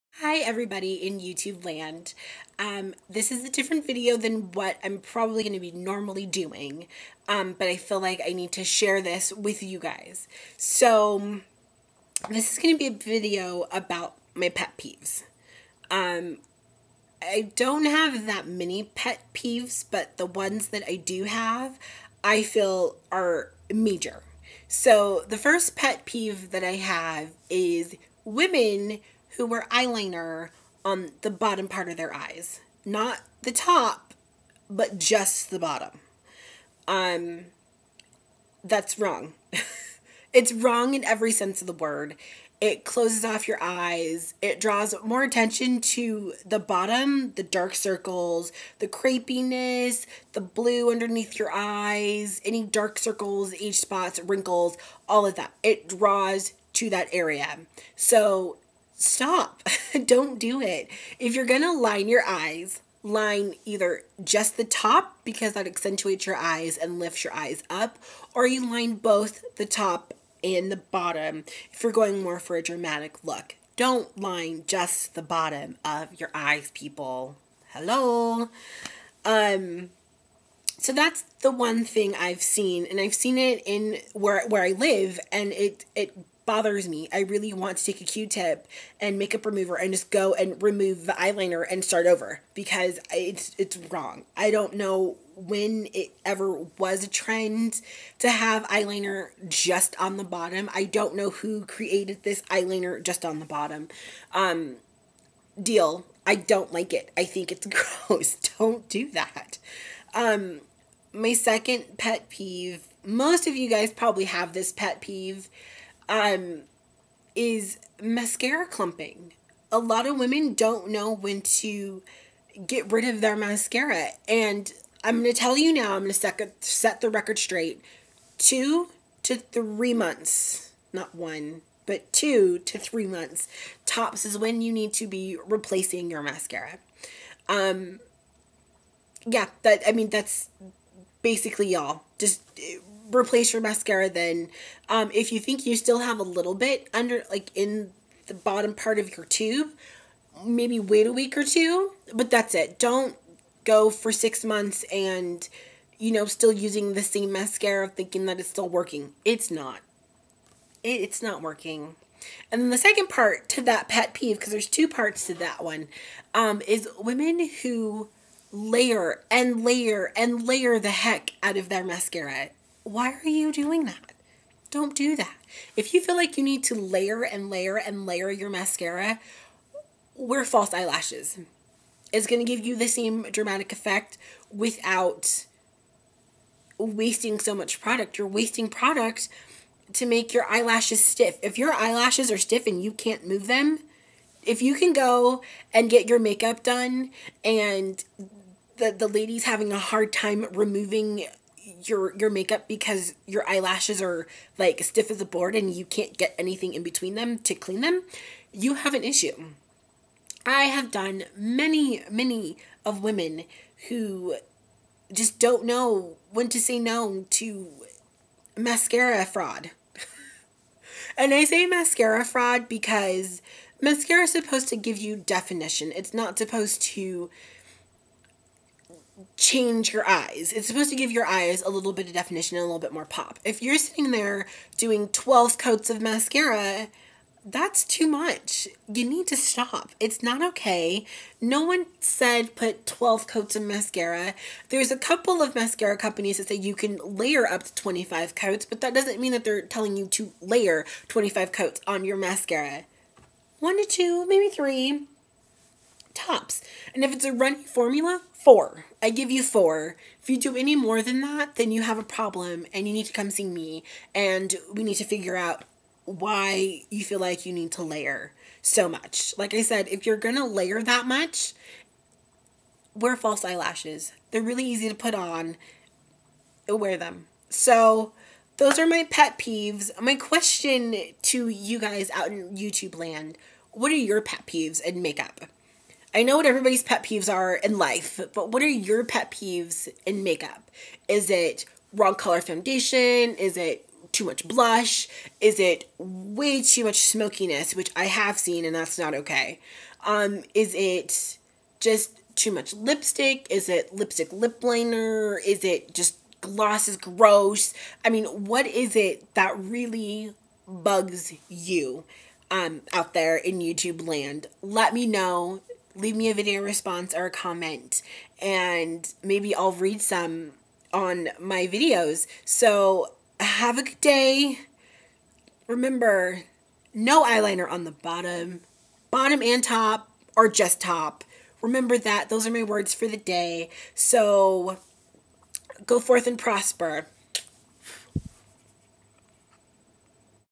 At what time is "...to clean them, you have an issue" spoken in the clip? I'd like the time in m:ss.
3:27.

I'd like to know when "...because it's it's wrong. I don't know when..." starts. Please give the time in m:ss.
1:32.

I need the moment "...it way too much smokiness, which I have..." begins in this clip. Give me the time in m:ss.
4:55.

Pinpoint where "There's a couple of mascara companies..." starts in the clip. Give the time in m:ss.
4:04.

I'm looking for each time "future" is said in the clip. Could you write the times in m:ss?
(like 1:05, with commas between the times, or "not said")
not said.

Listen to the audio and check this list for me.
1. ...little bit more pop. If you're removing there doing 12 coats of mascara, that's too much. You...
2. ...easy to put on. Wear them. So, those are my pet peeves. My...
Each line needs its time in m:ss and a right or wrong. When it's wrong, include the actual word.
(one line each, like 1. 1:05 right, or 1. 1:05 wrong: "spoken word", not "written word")
1. 3:52 wrong: "sitting", not "removing"
2. 4:34 right.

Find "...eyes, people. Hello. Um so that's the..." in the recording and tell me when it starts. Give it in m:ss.
1:16.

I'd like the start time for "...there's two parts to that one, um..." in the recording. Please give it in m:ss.
2:44.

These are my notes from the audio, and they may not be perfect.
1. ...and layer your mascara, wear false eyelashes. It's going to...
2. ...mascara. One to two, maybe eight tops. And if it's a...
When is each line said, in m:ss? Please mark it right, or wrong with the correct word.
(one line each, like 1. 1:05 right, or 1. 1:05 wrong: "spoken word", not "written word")
1. 2:57 right
2. 4:12 wrong: "three", not "eight".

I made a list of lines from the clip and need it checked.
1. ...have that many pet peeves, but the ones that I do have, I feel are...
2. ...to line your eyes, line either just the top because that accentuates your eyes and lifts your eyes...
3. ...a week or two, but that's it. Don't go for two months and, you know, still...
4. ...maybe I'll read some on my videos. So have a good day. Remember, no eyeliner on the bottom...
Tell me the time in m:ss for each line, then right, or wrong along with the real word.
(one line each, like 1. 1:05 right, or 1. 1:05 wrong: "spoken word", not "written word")
1. 0:17 right
2. 1:01 right
3. 2:31 wrong: "six", not "two"
4. 5:19 right.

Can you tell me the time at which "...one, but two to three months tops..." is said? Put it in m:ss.
2:11.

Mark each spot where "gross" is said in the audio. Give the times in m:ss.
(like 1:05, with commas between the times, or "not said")
1:47, 5:06.